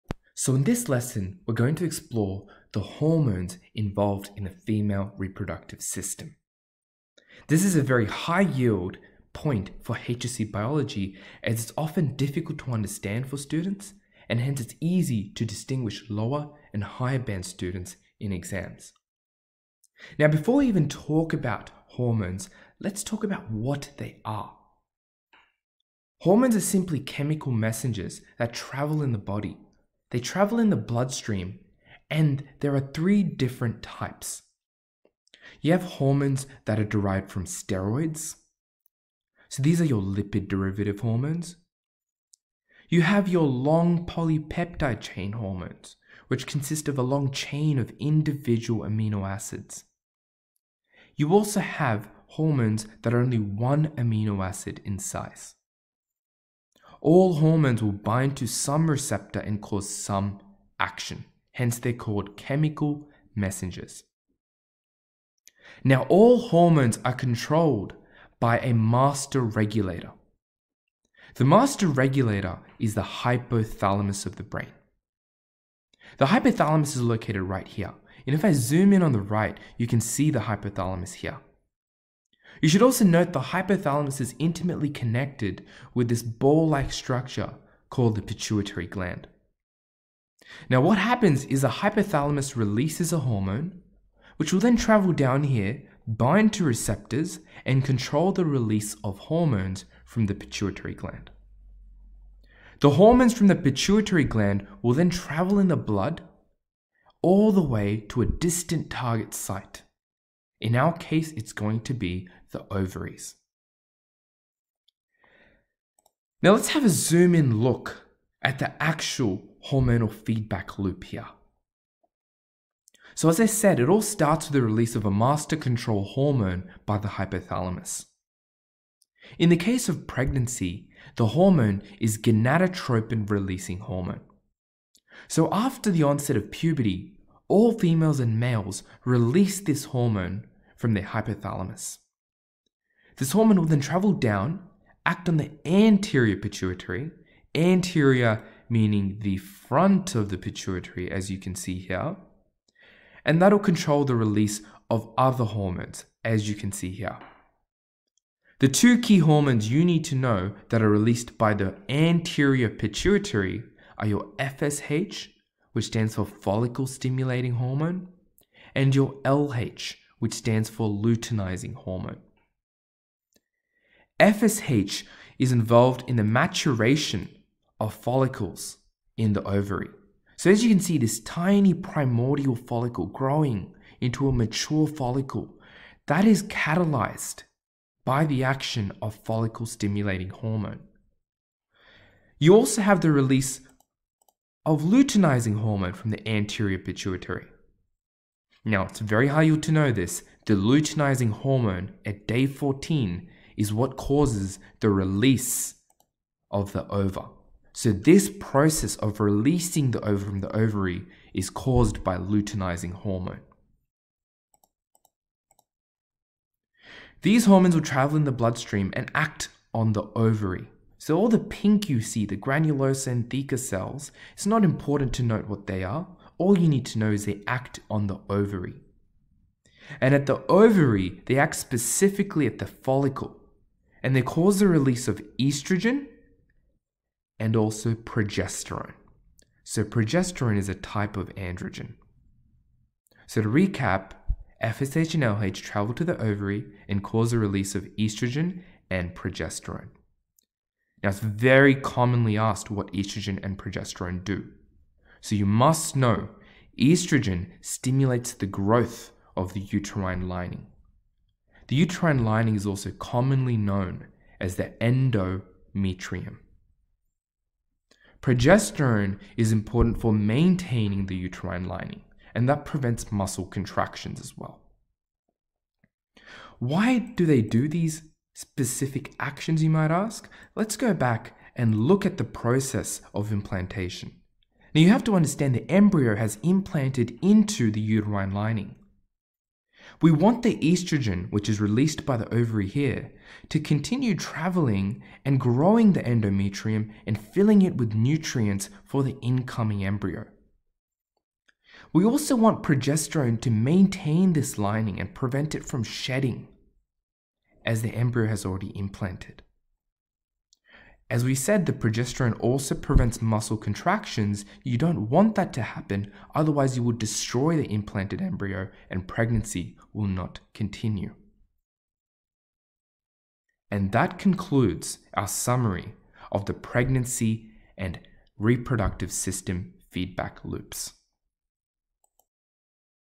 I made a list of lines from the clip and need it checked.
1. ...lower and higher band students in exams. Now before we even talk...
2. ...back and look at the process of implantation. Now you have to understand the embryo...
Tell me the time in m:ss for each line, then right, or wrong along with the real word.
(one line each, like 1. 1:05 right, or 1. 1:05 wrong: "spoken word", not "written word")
1. 0:16 right
2. 4:40 right.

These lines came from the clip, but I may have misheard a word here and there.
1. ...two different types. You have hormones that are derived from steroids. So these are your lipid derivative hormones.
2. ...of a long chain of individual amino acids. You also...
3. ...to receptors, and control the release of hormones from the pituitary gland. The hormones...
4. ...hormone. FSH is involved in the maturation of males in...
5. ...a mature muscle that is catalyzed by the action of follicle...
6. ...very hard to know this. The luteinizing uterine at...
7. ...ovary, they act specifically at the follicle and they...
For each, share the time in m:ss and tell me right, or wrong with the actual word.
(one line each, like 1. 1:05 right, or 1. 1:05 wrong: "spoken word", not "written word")
1. 0:32 wrong: "three", not "two"
2. 0:46 right
3. 1:36 right
4. 2:51 wrong: "follicles", not "males"
5. 3:04 wrong: "follicle", not "muscle"
6. 3:18 wrong: "hormone", not "uterine"
7. 3:50 right.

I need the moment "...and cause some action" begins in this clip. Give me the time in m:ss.
0:59.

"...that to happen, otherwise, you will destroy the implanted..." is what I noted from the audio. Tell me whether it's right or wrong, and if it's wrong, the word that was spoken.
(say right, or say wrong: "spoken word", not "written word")
right.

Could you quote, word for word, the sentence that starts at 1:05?
Now, all hormones are controlled by a master regulator.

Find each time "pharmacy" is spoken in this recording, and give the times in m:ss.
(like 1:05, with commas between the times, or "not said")
not said.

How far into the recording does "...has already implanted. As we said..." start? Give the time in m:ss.
5:08.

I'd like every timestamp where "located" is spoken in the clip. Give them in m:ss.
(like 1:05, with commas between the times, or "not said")
1:17.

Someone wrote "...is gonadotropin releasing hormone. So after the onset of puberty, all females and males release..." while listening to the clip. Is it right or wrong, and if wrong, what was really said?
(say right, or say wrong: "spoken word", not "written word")
right.